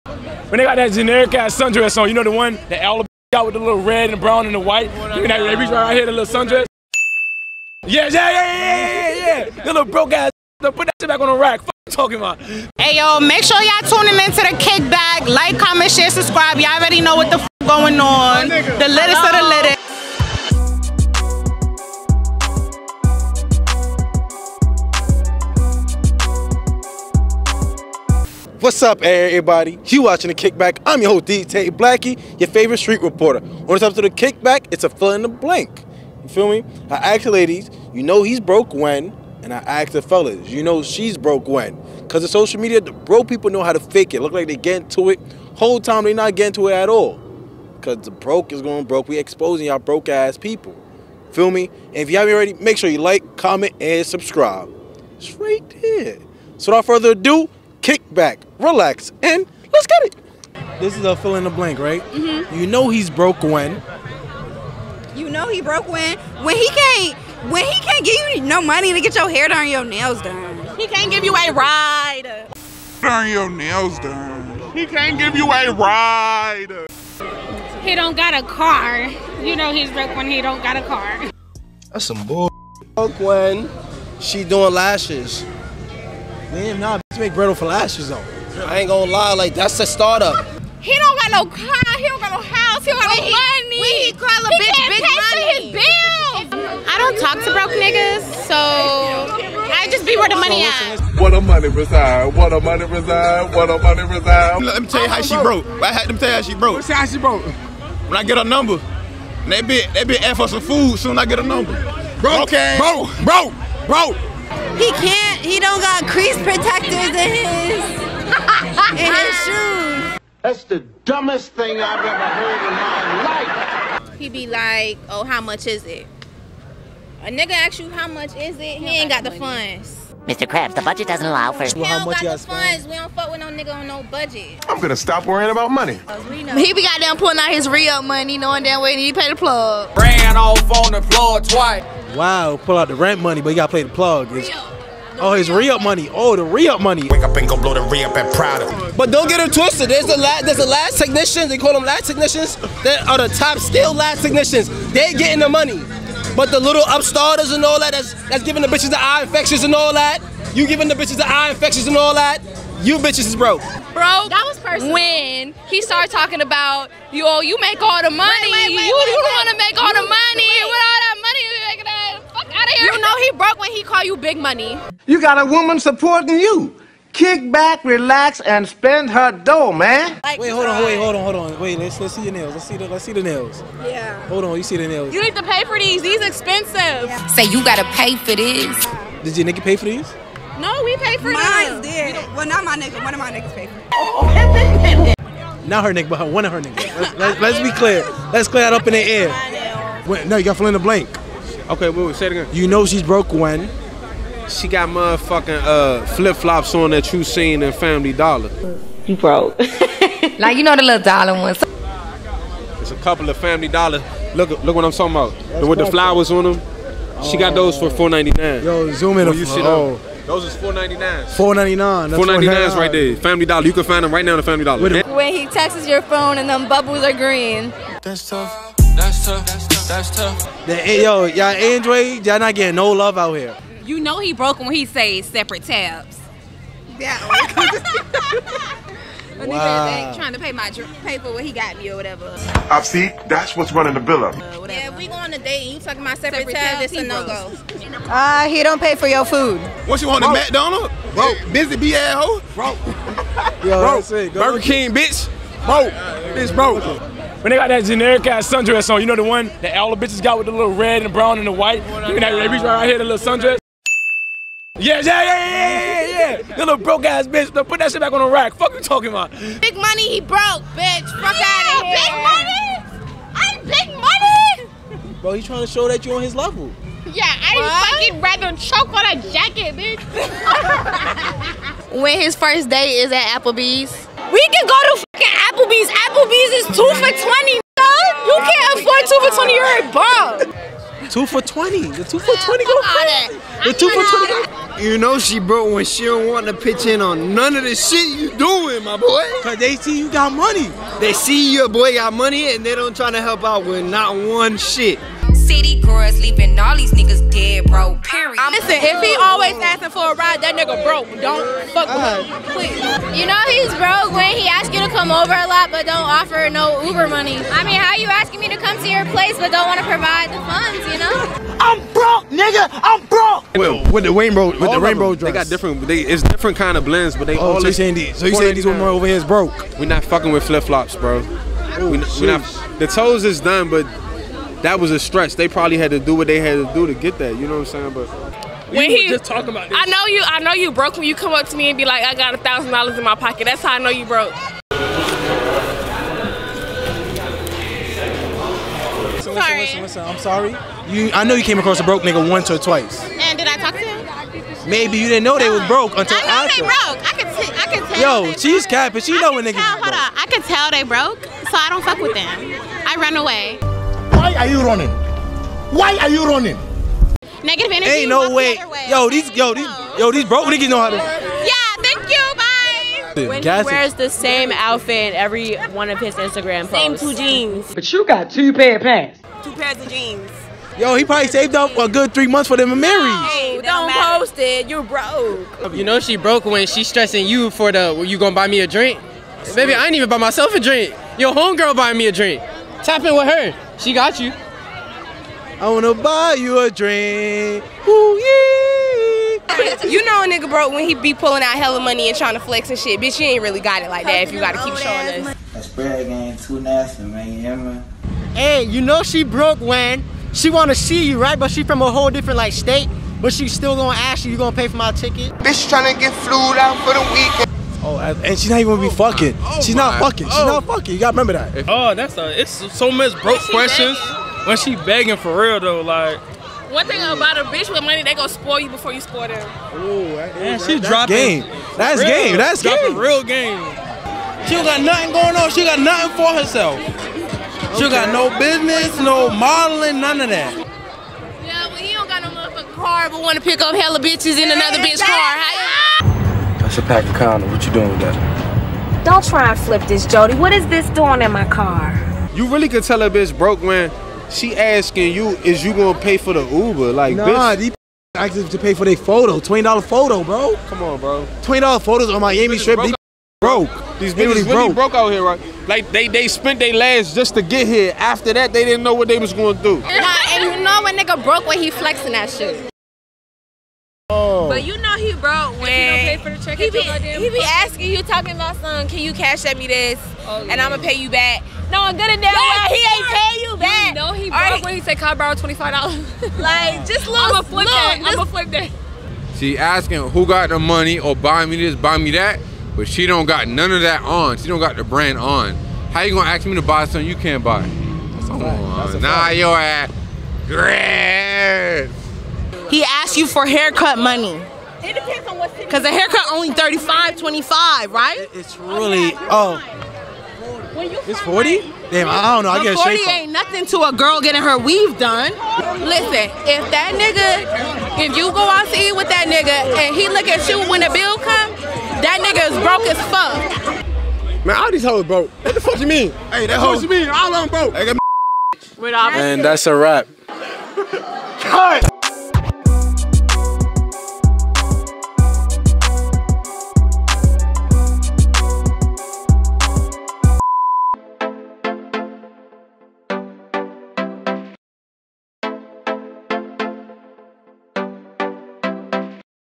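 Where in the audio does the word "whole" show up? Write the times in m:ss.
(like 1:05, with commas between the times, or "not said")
0:45, 6:51.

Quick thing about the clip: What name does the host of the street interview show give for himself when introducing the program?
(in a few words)
Dtay Blackie.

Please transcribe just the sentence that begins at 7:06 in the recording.
One thing about a bitch with money, they gonna spoil you before you spoil them.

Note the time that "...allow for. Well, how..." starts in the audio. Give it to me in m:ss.
2:11.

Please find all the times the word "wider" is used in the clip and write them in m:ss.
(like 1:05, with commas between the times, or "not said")
not said.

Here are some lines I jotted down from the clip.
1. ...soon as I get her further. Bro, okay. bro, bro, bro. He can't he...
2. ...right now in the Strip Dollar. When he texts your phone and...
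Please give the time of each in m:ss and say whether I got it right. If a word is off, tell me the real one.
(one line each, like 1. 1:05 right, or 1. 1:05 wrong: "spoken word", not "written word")
1. 1:50 wrong: "number", not "further"
2. 3:44 wrong: "Family", not "Strip".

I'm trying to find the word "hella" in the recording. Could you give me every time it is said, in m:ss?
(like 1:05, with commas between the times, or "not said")
6:41, 7:23.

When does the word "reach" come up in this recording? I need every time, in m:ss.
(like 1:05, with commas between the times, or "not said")
0:05, 4:22.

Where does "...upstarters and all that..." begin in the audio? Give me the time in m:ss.
2:36.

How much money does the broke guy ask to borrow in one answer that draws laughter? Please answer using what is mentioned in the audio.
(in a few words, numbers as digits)
$25.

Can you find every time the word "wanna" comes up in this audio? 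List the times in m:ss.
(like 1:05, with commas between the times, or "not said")
6:35, 6:50.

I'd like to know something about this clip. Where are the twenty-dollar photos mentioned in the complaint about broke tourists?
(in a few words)
Miami Strip.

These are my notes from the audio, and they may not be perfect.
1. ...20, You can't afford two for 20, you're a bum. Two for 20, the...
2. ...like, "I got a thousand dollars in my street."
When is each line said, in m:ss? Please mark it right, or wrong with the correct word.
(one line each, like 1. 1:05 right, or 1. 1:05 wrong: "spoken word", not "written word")
1. 4:47 right
2. 5:41 wrong: "pocket", not "street".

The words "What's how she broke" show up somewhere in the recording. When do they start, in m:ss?
1:46.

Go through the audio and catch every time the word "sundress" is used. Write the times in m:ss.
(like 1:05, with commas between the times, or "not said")
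0:01, 0:06, 4:18, 4:23.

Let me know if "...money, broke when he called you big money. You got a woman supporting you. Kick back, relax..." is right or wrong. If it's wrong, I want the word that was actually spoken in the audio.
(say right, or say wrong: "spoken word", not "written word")
right.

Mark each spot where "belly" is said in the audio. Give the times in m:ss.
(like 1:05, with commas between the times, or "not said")
not said.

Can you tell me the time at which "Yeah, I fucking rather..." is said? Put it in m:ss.
4:37.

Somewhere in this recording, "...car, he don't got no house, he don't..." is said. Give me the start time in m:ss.
1:31.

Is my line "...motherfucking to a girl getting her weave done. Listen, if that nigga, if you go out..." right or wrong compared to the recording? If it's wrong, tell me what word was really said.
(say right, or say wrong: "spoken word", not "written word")
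wrong: "nothing", not "motherfucking".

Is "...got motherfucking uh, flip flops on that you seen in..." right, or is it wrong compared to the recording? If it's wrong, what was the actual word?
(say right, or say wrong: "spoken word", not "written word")
right.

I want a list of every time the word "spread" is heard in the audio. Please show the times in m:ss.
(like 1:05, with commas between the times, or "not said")
6:45.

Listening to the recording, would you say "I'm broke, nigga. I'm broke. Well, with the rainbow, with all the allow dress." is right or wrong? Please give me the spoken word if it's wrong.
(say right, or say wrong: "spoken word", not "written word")
wrong: "rainbow", not "allow".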